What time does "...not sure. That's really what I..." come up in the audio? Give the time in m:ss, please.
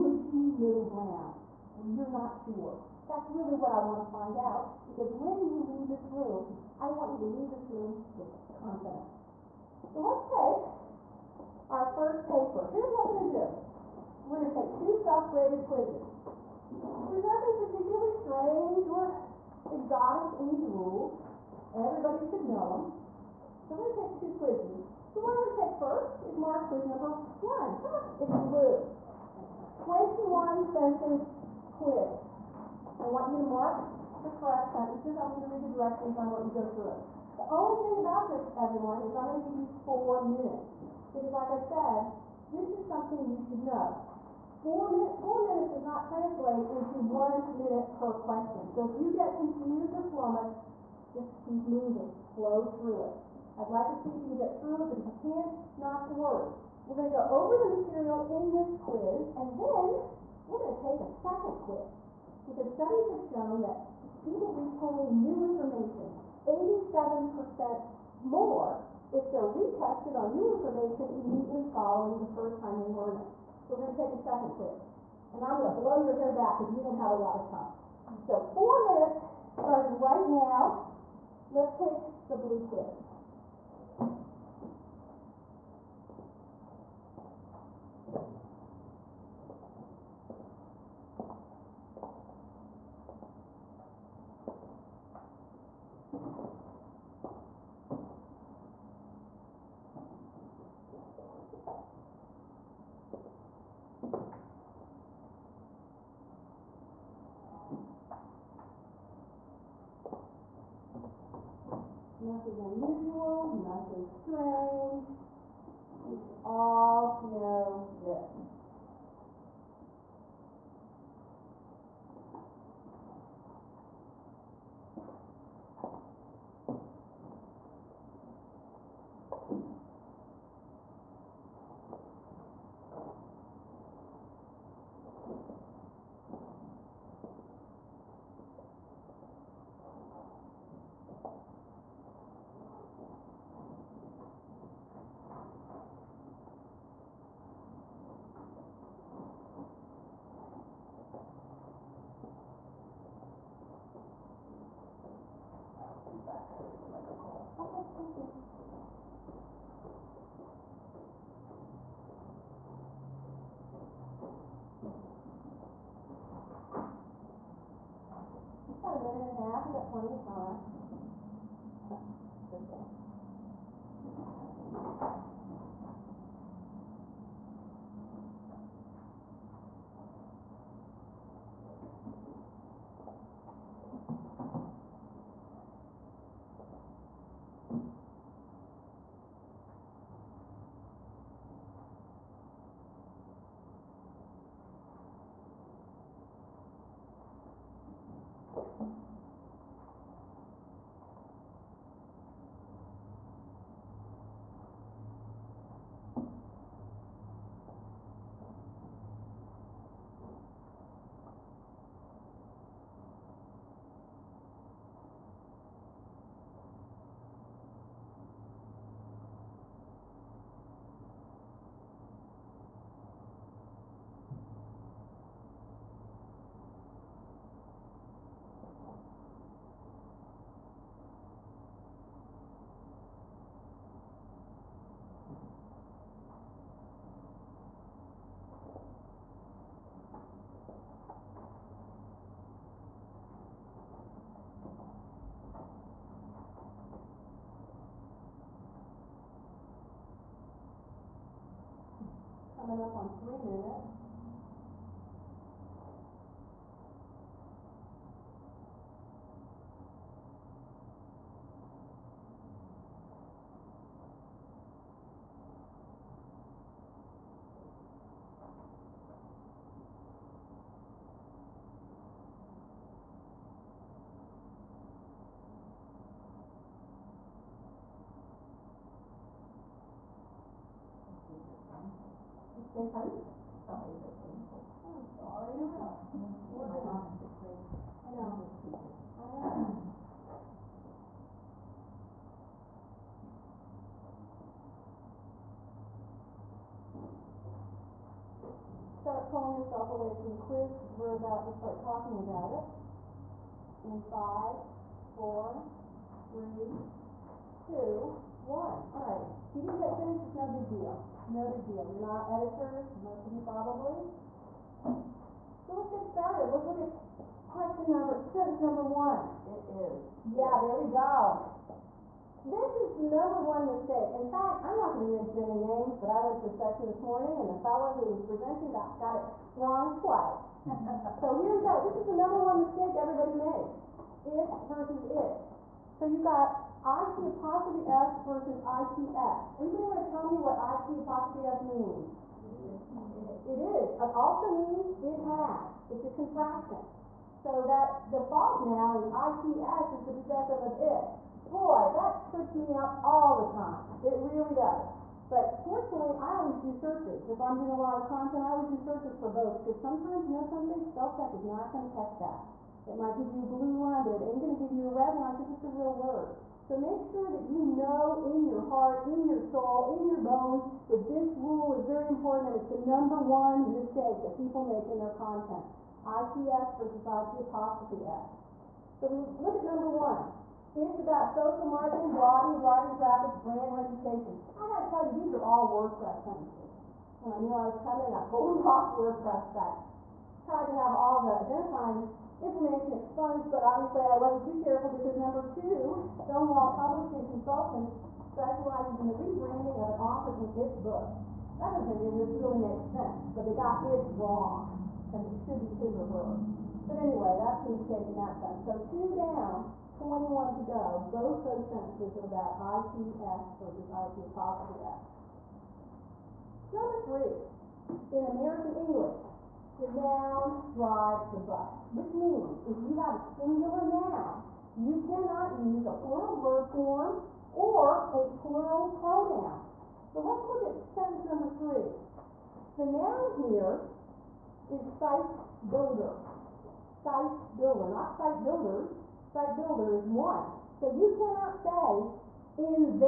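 0:02.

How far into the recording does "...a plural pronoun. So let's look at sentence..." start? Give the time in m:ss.
7:08.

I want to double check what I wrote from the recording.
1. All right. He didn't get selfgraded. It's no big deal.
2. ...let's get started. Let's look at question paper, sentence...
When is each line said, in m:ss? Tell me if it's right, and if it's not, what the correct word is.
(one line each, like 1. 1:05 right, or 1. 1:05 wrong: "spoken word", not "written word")
1. 5:08 wrong: "finished", not "selfgraded"
2. 5:15 wrong: "number", not "paper".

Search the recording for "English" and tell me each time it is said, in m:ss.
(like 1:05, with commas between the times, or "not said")
6:58.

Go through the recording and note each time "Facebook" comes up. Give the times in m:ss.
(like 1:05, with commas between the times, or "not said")
4:44.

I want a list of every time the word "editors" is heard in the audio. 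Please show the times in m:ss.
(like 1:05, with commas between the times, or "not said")
5:12.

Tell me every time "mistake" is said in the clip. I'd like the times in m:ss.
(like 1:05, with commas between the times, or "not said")
5:23, 5:32, 6:13, 6:47.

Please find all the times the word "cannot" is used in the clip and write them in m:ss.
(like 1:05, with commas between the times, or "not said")
7:05, 7:21.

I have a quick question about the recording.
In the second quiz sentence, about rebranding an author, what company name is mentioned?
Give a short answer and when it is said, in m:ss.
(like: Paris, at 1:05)
Stonewall Publishing Consultants, at 6:36.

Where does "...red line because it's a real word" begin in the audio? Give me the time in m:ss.
6:04.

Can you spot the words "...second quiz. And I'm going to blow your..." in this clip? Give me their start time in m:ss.
1:14.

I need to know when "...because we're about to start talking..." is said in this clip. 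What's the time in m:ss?
5:00.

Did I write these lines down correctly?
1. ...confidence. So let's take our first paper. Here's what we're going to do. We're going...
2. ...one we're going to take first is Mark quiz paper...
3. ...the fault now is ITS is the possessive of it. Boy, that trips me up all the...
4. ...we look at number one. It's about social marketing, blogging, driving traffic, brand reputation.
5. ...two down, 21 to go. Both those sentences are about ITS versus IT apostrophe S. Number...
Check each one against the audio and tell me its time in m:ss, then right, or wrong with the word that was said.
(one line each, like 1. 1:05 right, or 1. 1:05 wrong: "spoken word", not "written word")
1. 0:08 right
2. 0:25 wrong: "number", not "paper"
3. 5:48 right
4. 6:19 right
5. 6:48 right.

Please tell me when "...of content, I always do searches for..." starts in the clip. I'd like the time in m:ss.
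5:58.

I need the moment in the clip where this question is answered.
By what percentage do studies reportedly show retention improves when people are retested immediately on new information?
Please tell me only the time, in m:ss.
1:06.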